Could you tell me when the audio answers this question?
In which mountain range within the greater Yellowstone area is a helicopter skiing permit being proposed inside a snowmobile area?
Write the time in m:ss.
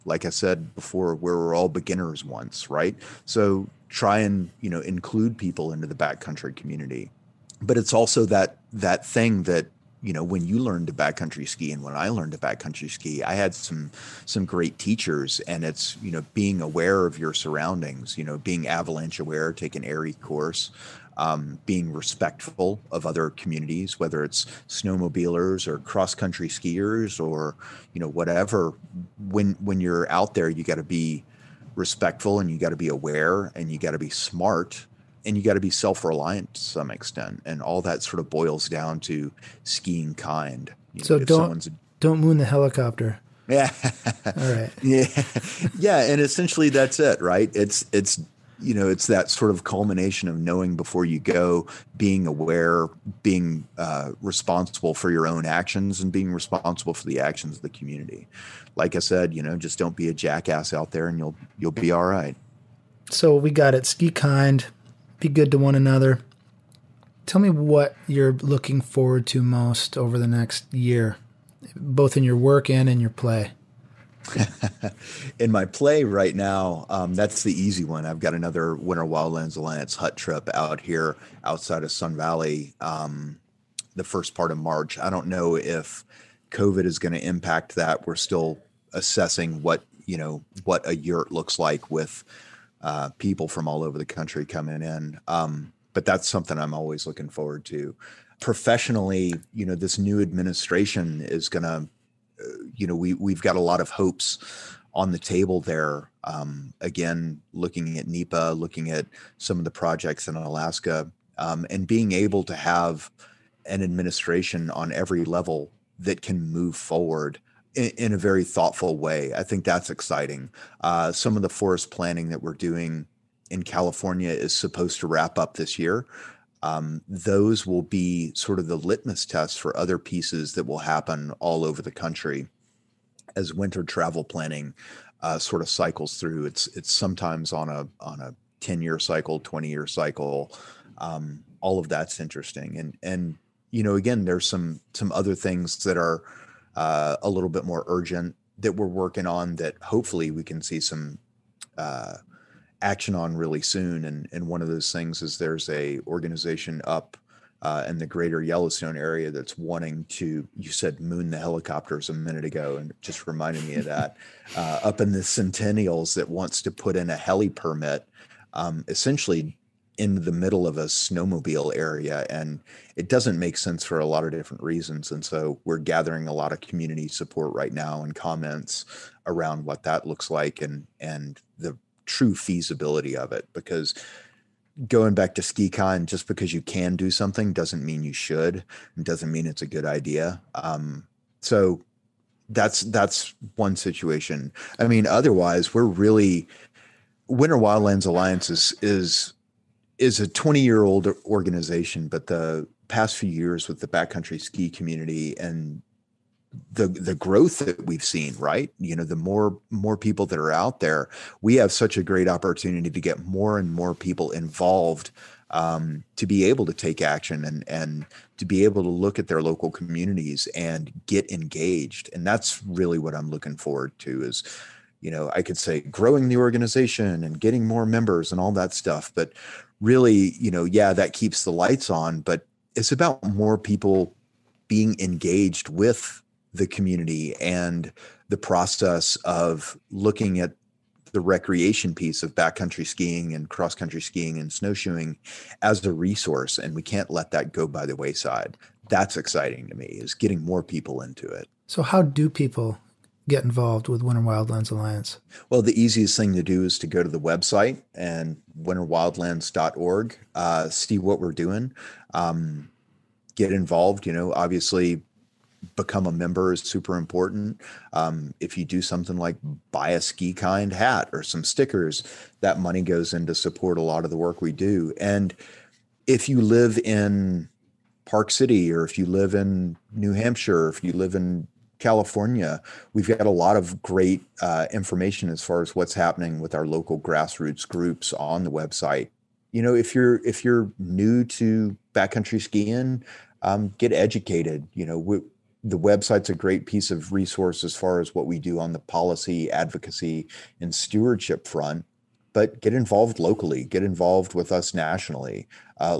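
2:45.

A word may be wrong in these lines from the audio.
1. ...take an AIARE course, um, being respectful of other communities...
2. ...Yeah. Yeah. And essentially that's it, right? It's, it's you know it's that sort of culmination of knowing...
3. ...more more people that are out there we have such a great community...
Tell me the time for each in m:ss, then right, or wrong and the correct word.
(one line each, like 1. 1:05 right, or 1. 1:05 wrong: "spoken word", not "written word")
1. 0:19 right
2. 0:44 right
3. 3:29 wrong: "opportunity", not "community".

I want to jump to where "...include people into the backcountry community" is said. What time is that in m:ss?
0:04.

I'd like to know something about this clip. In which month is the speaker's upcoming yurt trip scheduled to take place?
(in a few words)
March.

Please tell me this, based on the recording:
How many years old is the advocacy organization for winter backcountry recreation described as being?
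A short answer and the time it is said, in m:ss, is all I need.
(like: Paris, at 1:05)
20, at 3:20.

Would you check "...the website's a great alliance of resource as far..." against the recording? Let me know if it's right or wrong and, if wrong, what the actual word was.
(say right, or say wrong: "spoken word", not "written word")
wrong: "piece", not "alliance".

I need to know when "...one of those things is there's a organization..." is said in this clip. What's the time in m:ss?
2:34.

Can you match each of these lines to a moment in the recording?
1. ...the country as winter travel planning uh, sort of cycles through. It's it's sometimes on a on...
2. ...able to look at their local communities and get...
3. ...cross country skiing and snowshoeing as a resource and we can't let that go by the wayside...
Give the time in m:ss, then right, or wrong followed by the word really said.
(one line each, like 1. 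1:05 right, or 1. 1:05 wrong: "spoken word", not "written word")
1. 2:11 right
2. 3:38 right
3. 4:03 right.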